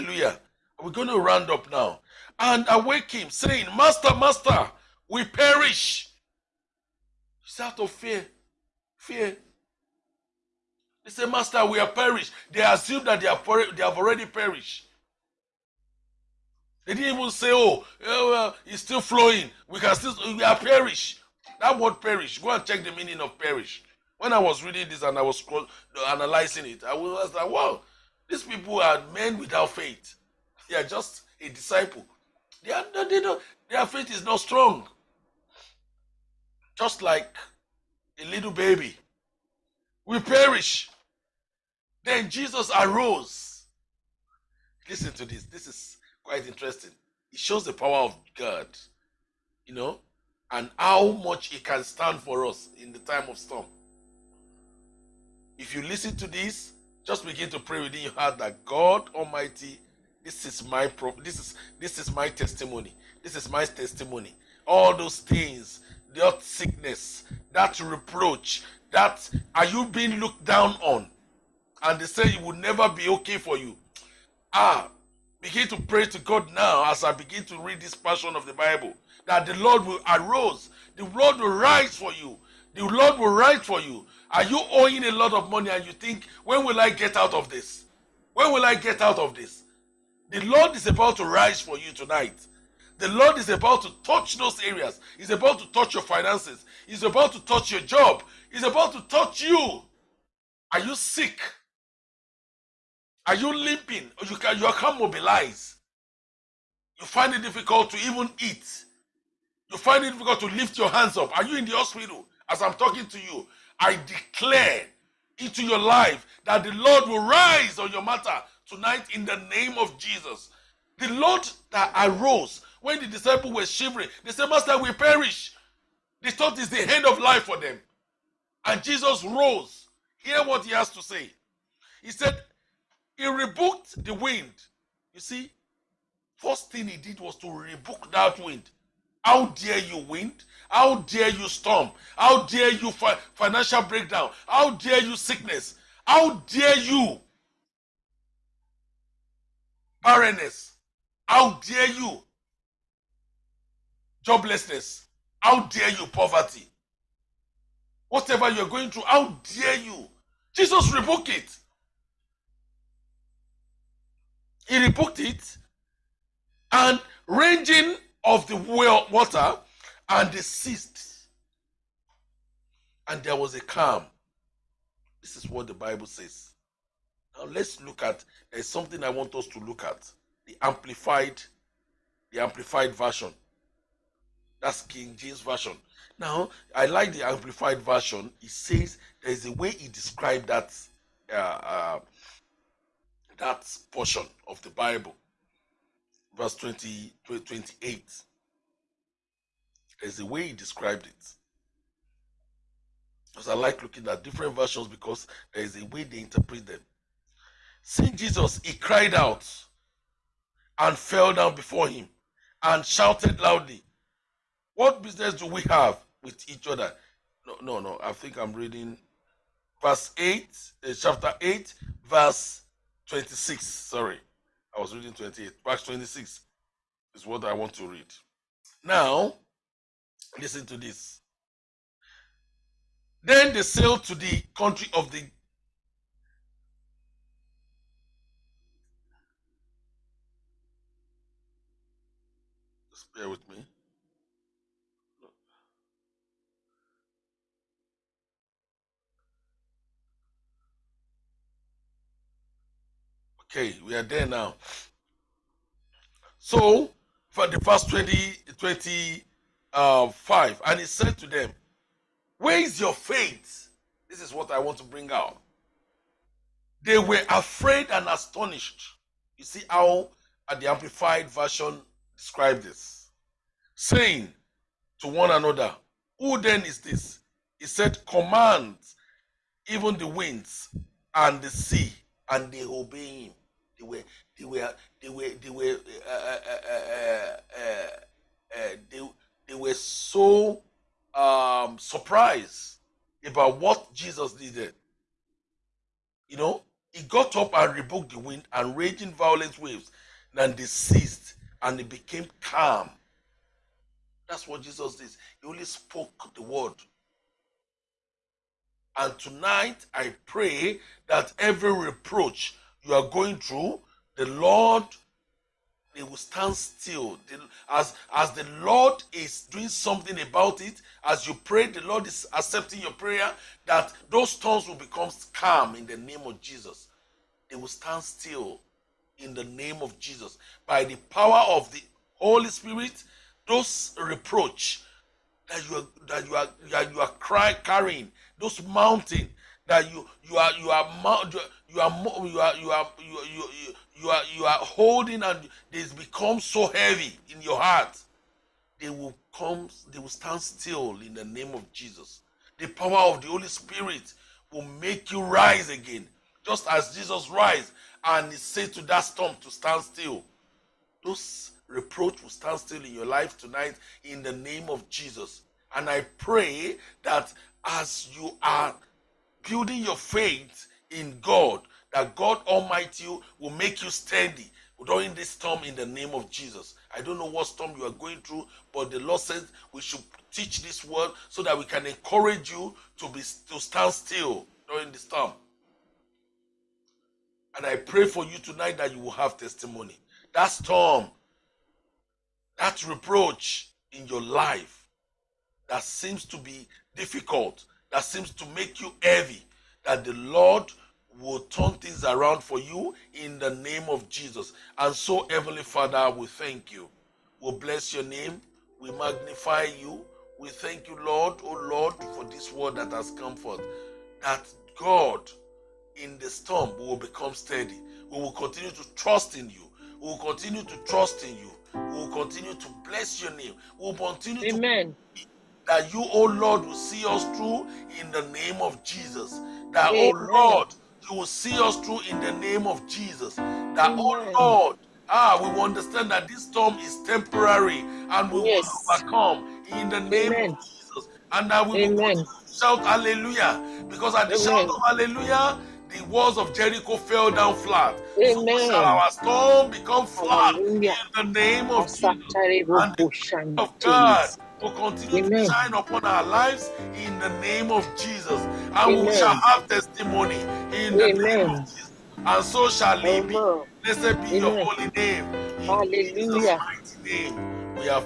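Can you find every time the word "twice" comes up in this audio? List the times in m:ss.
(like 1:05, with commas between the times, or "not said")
not said.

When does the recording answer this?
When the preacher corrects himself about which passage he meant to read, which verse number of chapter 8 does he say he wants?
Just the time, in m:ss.
3:45.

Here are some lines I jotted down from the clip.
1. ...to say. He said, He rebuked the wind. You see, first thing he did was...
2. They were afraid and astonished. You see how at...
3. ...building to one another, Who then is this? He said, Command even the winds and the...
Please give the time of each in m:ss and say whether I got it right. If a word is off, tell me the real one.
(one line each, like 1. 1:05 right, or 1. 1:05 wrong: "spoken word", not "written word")
1. 2:10 right
2. 4:26 right
3. 4:33 wrong: "saying", not "building".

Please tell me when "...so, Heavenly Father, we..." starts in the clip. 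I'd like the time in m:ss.
6:44.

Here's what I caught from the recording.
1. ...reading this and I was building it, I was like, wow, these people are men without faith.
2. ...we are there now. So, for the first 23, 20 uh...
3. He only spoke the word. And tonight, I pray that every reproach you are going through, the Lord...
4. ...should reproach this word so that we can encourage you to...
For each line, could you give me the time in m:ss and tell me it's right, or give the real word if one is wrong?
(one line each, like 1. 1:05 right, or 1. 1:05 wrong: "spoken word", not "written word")
1. 0:24 wrong: "analyzing", not "building"
2. 4:13 wrong: "20", not "23"
3. 5:05 right
4. 6:19 wrong: "teach", not "reproach".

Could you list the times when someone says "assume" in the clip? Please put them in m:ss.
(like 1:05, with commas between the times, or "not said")
0:12.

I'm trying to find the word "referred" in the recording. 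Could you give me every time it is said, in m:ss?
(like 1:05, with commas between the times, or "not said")
not said.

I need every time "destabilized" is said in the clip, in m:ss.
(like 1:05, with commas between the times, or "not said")
not said.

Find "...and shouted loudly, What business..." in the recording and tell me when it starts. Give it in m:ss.
3:32.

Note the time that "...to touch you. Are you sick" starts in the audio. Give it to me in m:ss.
1:38.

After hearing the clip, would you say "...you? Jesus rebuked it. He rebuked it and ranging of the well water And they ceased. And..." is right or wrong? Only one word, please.
right.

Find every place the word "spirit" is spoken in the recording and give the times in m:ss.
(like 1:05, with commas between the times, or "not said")
5:32, 5:53.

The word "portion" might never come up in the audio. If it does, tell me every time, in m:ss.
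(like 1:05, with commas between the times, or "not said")
1:17, 3:13.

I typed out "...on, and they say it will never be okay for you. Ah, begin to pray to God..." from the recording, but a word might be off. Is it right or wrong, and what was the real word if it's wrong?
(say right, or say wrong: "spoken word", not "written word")
right.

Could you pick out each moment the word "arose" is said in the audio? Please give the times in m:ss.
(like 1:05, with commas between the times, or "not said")
0:42, 2:01.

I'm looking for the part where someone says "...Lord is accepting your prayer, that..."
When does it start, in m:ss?
5:21.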